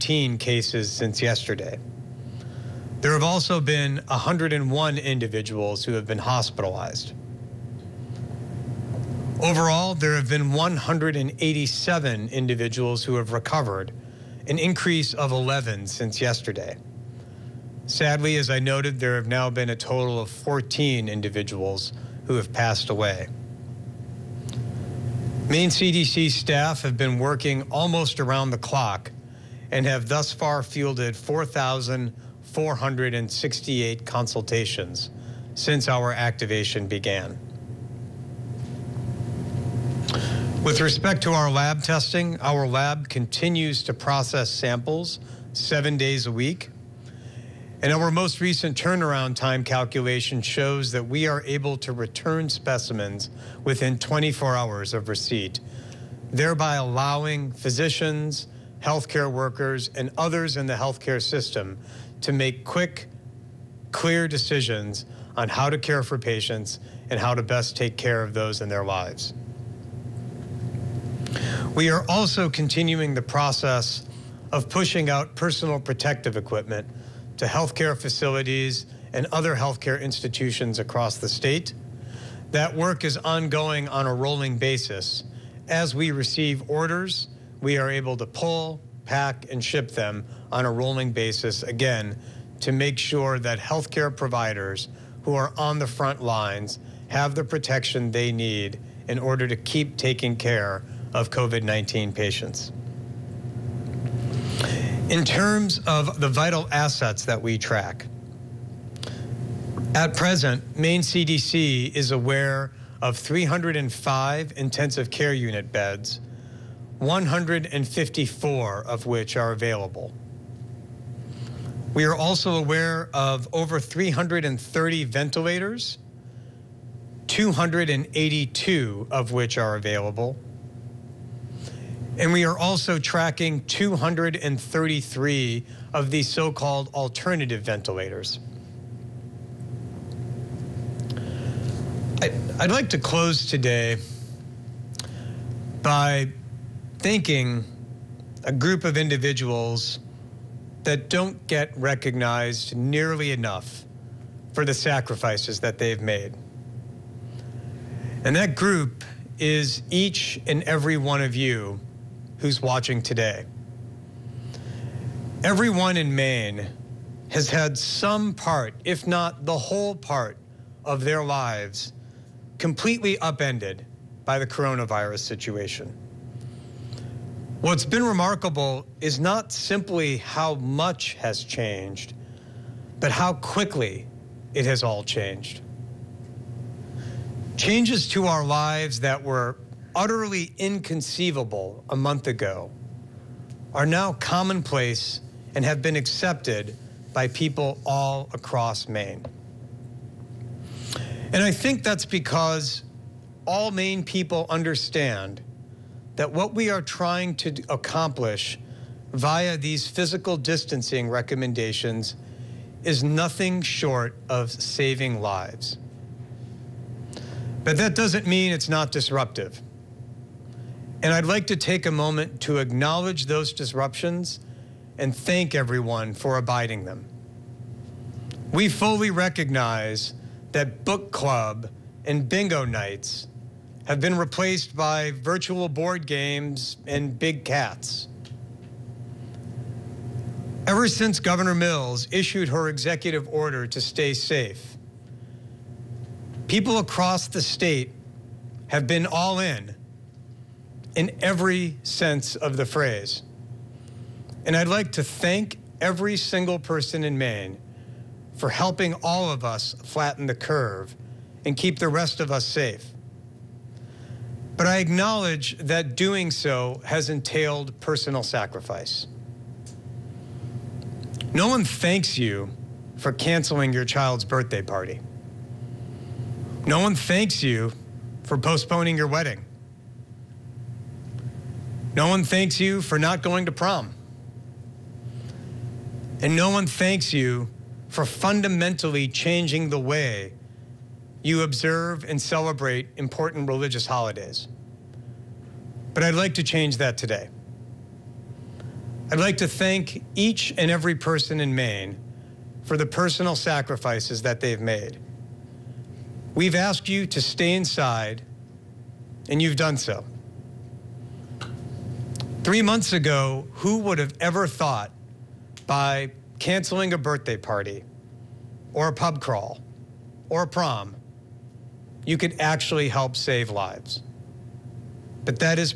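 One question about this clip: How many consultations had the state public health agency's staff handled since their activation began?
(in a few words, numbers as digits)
4,468.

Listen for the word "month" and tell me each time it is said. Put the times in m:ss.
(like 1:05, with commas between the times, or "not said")
3:11, 5:12.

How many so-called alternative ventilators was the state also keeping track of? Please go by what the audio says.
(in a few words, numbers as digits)
233.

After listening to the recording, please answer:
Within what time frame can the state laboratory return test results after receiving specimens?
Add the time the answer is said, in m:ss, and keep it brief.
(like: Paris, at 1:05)
24 hours, at 0:53.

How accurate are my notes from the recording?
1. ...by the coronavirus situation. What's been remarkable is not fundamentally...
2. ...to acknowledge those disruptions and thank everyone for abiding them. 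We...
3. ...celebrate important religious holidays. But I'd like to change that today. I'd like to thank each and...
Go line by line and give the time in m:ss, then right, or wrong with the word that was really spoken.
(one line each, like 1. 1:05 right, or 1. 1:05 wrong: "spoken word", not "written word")
1. 2:54 wrong: "simply", not "fundamentally"
2. 3:42 right
3. 4:52 right.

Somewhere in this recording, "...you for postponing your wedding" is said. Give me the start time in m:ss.
4:37.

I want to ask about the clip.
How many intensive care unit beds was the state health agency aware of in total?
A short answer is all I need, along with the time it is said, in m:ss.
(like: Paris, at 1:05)
305, at 1:53.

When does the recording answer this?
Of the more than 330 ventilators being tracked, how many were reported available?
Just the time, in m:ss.
2:07.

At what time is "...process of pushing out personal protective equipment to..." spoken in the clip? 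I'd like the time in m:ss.
1:13.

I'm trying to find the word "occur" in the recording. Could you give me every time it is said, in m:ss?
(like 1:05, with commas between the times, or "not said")
not said.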